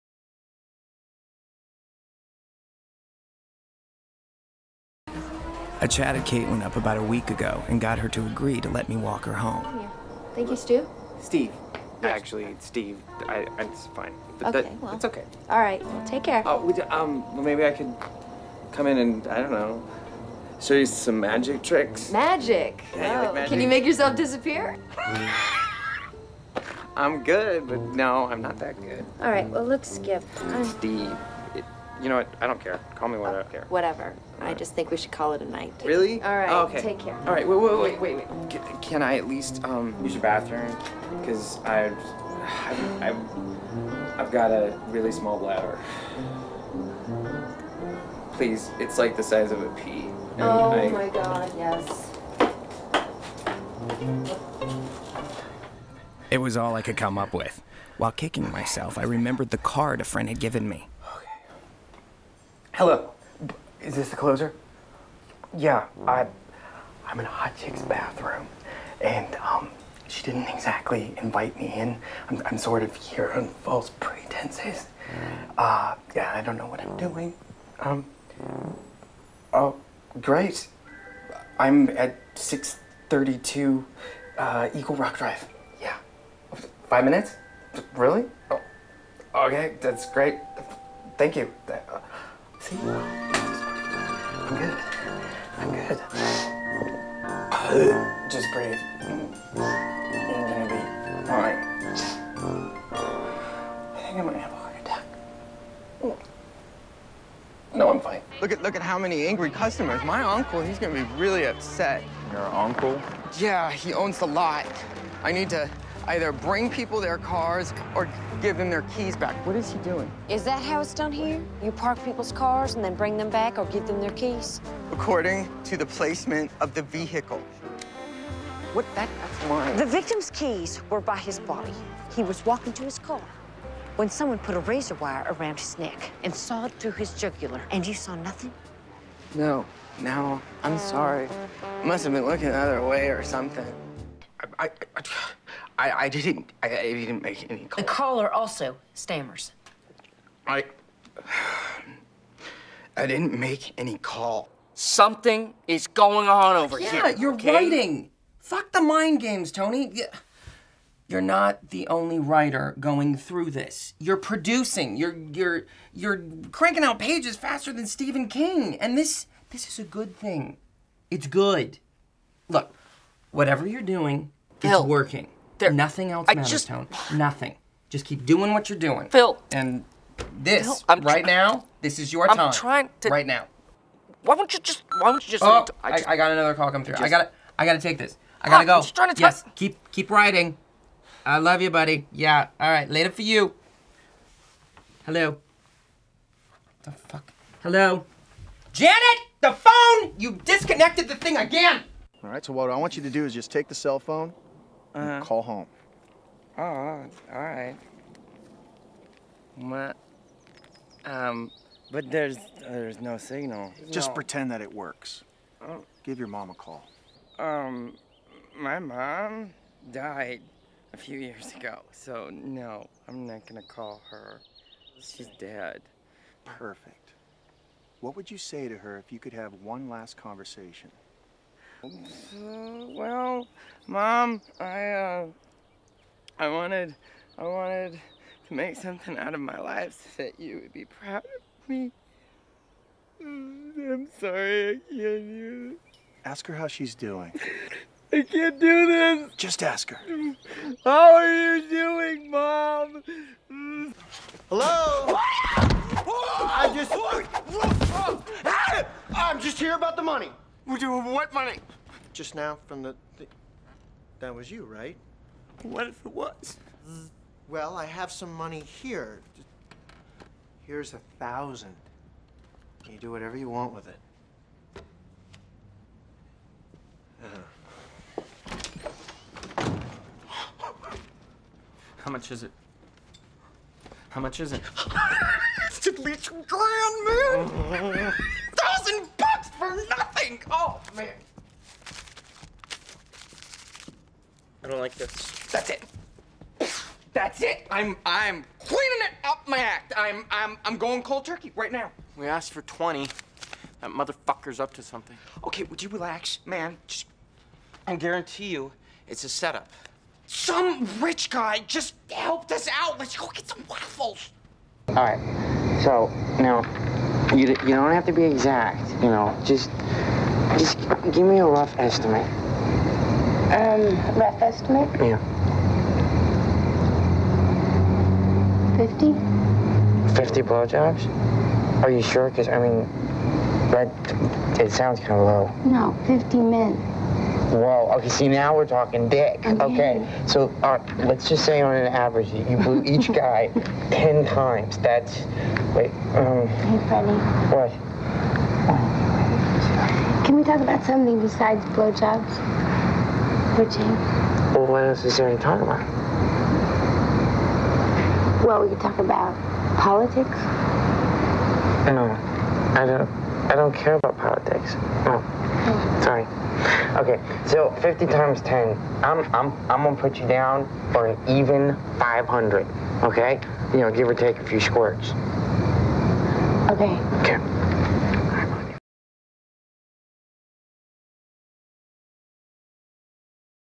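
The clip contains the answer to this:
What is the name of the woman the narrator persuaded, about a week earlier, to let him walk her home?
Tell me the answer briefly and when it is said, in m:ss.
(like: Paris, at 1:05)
Caitlin, at 0:06.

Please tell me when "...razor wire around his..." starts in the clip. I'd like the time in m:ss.
2:14.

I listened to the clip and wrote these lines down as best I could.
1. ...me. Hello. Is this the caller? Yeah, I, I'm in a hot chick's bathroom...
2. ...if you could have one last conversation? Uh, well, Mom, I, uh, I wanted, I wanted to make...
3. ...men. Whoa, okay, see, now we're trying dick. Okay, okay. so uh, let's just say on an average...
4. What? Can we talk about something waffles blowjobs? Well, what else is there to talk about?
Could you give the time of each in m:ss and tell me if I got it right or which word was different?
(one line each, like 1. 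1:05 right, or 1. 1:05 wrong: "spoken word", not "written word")
1. 1:00 wrong: "closer", not "caller"
2. 3:48 right
3. 5:36 wrong: "talking", not "trying"
4. 5:47 wrong: "besides", not "waffles".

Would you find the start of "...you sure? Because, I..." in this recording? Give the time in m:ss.
5:31.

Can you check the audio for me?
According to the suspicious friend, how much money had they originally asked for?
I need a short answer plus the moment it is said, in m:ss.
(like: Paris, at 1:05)
20, at 5:02.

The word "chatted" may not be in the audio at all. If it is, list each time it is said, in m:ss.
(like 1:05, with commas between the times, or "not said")
0:05.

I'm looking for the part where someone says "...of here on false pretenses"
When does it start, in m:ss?
1:12.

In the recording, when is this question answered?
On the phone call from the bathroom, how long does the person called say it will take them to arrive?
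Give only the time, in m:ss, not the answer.
1:26.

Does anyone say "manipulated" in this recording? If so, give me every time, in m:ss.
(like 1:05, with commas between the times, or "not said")
not said.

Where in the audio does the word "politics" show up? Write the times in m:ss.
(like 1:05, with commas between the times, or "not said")
5:59, 6:04.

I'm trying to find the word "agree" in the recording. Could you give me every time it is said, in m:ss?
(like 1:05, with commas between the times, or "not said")
0:08.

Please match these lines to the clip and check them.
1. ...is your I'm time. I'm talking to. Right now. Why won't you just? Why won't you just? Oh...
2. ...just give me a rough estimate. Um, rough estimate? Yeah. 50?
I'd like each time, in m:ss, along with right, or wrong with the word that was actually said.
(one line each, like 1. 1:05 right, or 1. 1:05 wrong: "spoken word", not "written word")
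1. 3:01 wrong: "trying", not "talking"
2. 5:20 right.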